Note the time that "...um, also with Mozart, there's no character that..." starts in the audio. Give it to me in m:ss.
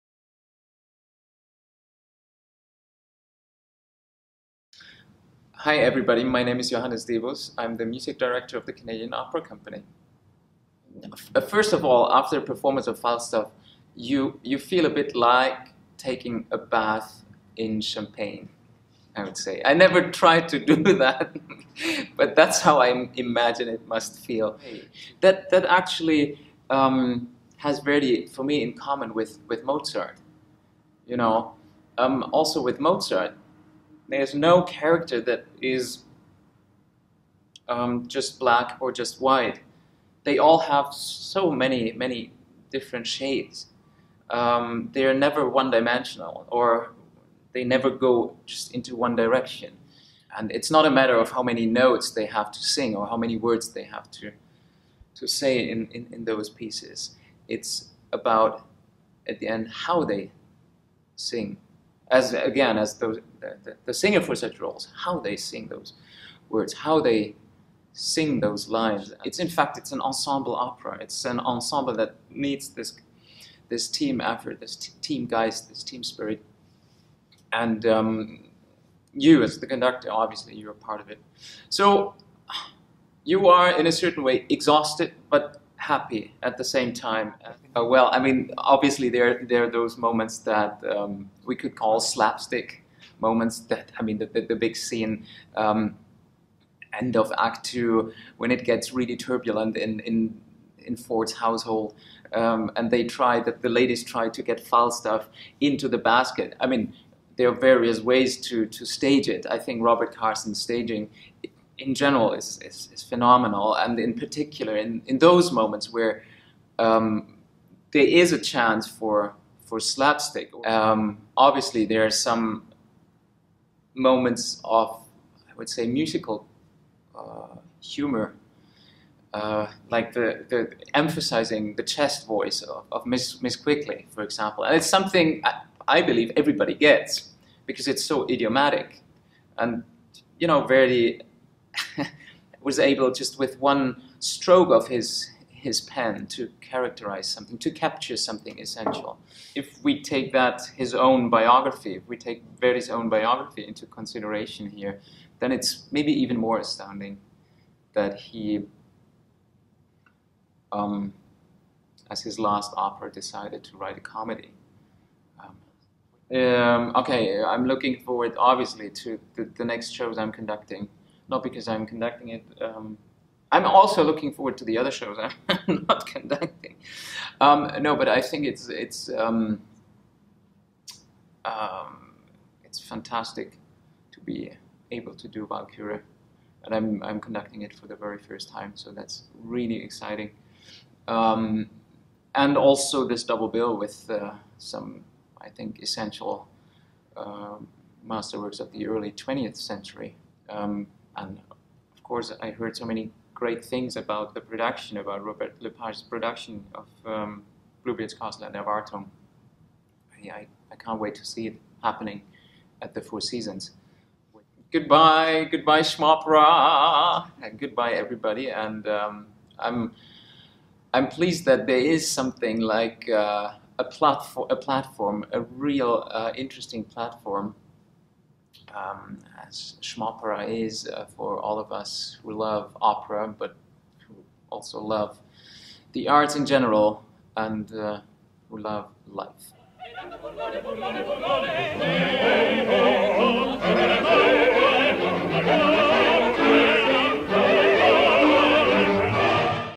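0:31.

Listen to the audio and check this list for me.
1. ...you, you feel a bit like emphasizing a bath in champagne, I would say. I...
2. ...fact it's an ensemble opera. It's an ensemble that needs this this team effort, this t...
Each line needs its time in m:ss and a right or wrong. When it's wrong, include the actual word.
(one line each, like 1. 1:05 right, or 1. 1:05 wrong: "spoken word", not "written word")
1. 0:13 wrong: "taking", not "emphasizing"
2. 1:09 right.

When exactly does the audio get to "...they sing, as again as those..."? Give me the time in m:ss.
1:00.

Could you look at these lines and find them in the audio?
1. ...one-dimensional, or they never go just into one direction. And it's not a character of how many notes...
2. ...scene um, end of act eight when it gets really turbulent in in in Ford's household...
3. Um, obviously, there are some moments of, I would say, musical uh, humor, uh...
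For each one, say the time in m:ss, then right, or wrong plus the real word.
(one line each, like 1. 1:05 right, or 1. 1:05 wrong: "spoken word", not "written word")
1. 0:45 wrong: "matter", not "character"
2. 1:34 wrong: "two", not "eight"
3. 2:00 right.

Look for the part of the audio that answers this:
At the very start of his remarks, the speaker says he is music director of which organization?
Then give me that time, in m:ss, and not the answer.
0:08.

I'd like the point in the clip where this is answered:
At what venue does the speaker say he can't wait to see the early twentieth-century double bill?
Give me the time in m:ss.
3:33.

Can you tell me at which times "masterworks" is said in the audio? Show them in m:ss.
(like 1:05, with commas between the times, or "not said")
3:18.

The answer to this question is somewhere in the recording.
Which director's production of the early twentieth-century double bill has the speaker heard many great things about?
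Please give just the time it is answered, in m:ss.
3:25.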